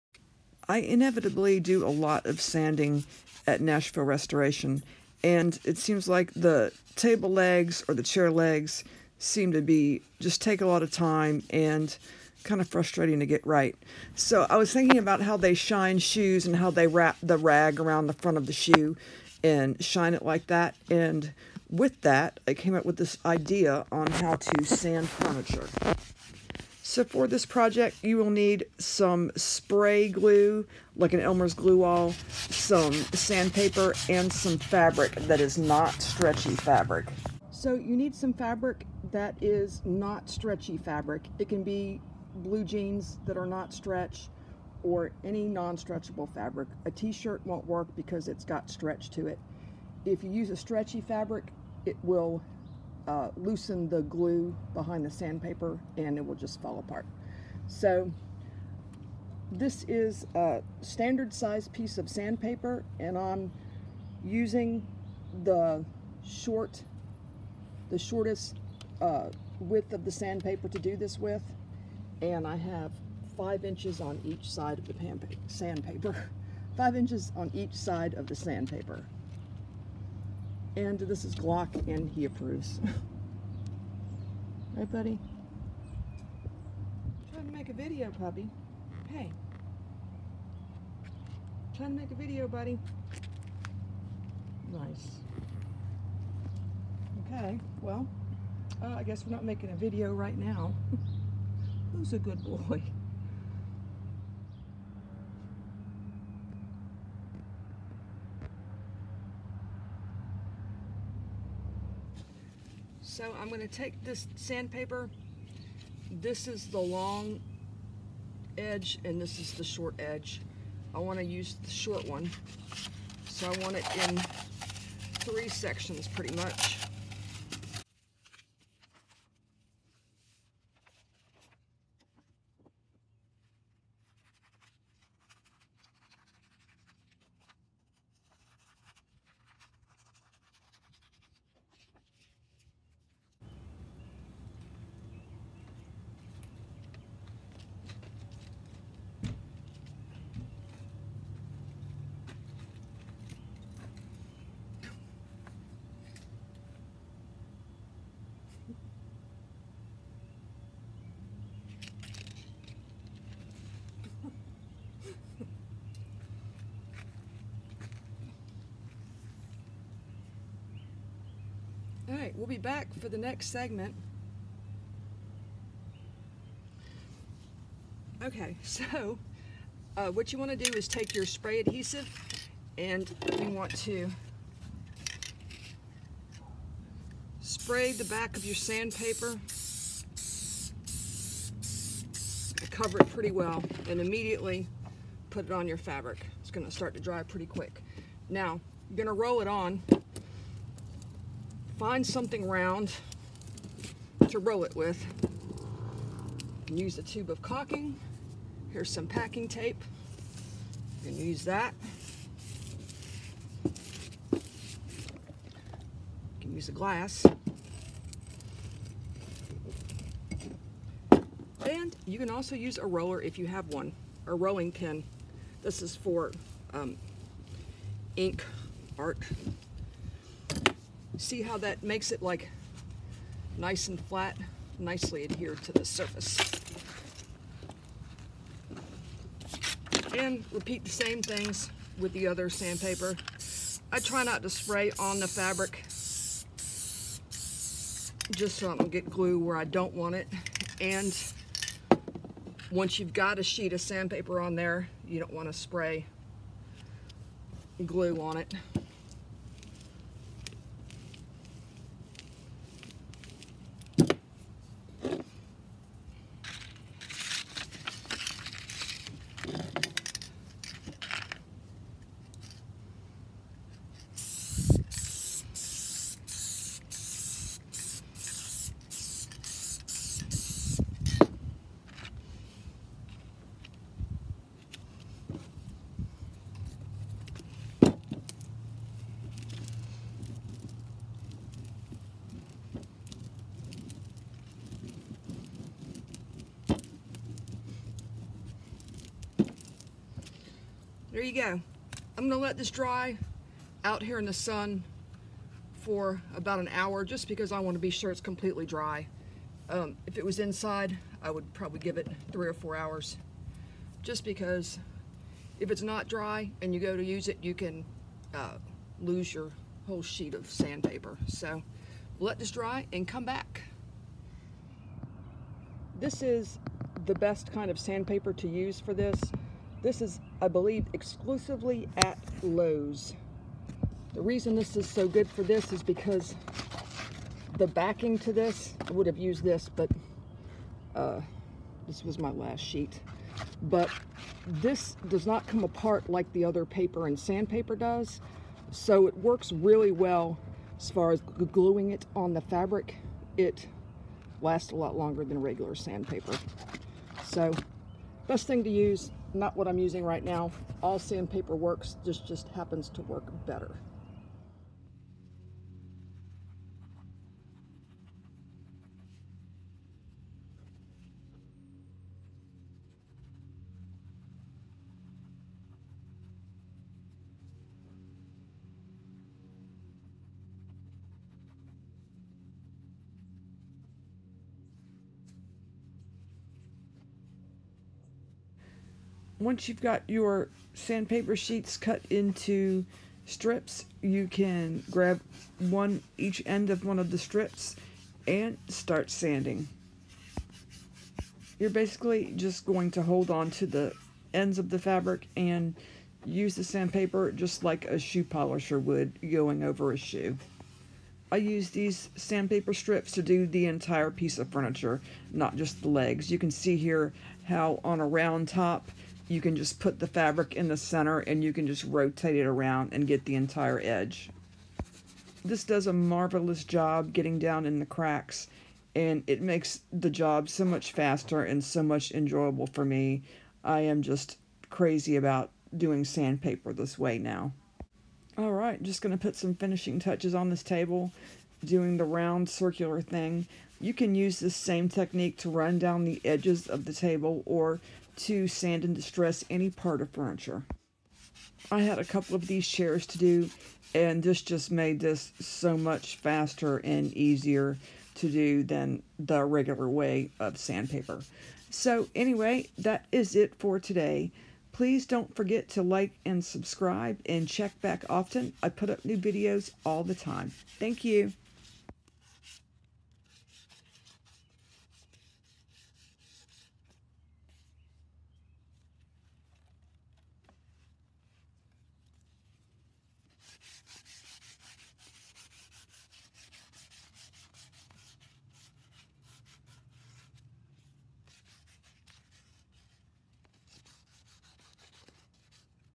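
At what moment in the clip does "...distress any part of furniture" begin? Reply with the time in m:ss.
7:28.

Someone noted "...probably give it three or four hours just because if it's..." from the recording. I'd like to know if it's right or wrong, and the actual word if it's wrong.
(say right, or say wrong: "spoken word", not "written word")
right.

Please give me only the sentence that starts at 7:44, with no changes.
Please don't forget to like and subscribe and check back often.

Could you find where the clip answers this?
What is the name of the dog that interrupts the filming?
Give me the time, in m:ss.
1:21.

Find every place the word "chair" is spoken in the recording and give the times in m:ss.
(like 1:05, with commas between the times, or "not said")
0:08, 7:32.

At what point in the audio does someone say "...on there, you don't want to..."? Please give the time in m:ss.
4:14.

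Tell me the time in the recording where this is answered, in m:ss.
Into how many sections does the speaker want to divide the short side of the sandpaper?
2:05.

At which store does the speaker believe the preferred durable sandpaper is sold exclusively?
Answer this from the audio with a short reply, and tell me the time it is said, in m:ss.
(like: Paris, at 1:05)
Lowe's, at 5:32.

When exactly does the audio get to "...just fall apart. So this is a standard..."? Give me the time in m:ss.
0:56.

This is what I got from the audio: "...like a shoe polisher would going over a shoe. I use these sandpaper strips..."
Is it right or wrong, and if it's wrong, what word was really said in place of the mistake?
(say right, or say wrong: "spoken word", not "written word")
right.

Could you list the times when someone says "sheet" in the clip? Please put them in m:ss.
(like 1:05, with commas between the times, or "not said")
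4:13, 5:20, 5:42, 6:31.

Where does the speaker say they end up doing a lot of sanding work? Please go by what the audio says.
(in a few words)
Nashville Restoration.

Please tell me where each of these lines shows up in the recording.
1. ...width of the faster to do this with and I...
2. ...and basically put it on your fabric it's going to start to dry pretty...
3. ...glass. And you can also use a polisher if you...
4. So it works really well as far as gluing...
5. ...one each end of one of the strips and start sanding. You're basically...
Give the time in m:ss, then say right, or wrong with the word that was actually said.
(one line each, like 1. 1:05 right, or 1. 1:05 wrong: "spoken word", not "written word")
1. 1:09 wrong: "sandpaper", not "faster"
2. 3:13 wrong: "immediately", not "basically"
3. 3:36 wrong: "roller", not "polisher"
4. 5:48 right
5. 6:35 right.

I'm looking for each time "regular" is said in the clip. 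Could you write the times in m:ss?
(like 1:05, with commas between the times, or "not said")
5:55, 7:39.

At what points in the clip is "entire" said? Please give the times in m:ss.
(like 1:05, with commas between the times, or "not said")
6:53, 7:03.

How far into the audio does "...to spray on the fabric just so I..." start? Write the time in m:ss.
4:04.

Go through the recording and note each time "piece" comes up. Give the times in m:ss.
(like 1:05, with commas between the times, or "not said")
1:01, 6:54.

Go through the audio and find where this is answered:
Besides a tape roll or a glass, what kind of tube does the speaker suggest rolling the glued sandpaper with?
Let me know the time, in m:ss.
3:27.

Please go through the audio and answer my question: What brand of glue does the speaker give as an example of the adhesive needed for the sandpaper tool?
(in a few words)
Elmer's.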